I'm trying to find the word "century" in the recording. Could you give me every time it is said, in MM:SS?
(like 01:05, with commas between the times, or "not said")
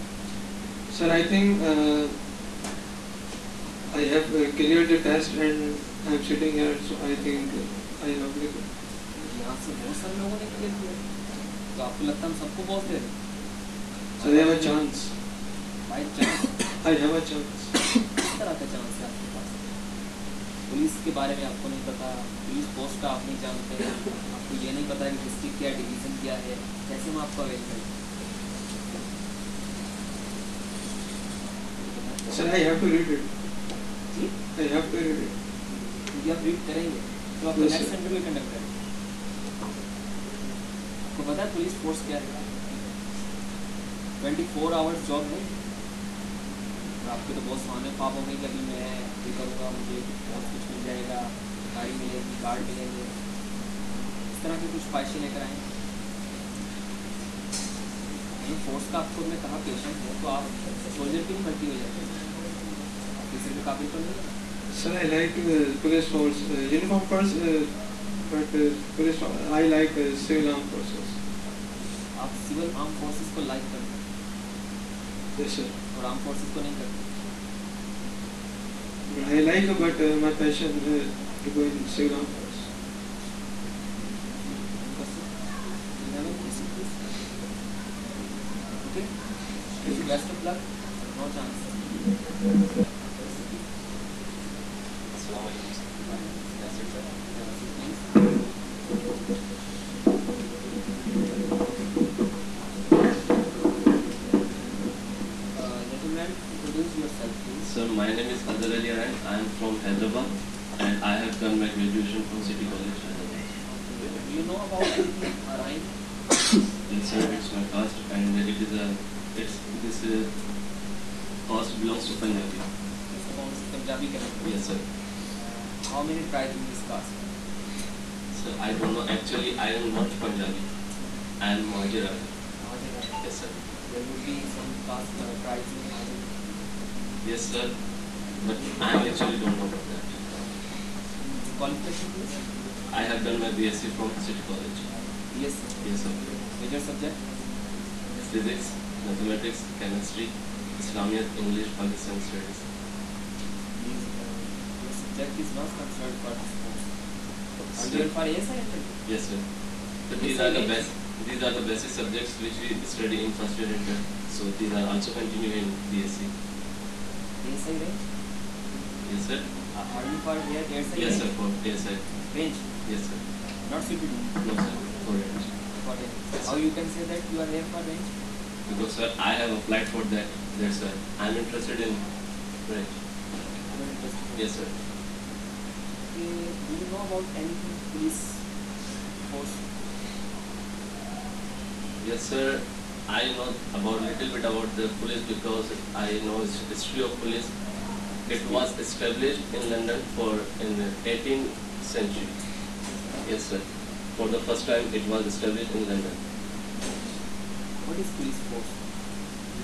03:21.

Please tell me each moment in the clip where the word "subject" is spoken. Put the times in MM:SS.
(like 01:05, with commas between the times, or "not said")
02:26, 02:34, 02:41.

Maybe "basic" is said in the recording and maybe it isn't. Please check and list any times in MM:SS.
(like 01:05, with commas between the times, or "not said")
02:41.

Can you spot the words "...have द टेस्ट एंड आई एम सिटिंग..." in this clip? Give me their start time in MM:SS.
00:04.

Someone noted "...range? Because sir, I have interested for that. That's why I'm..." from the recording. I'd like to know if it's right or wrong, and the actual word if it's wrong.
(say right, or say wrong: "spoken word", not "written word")
wrong: "applied", not "interested".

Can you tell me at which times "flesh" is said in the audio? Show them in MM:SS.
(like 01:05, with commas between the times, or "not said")
not said.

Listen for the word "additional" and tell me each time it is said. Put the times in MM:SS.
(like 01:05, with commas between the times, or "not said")
not said.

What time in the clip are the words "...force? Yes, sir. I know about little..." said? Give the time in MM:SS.
03:09.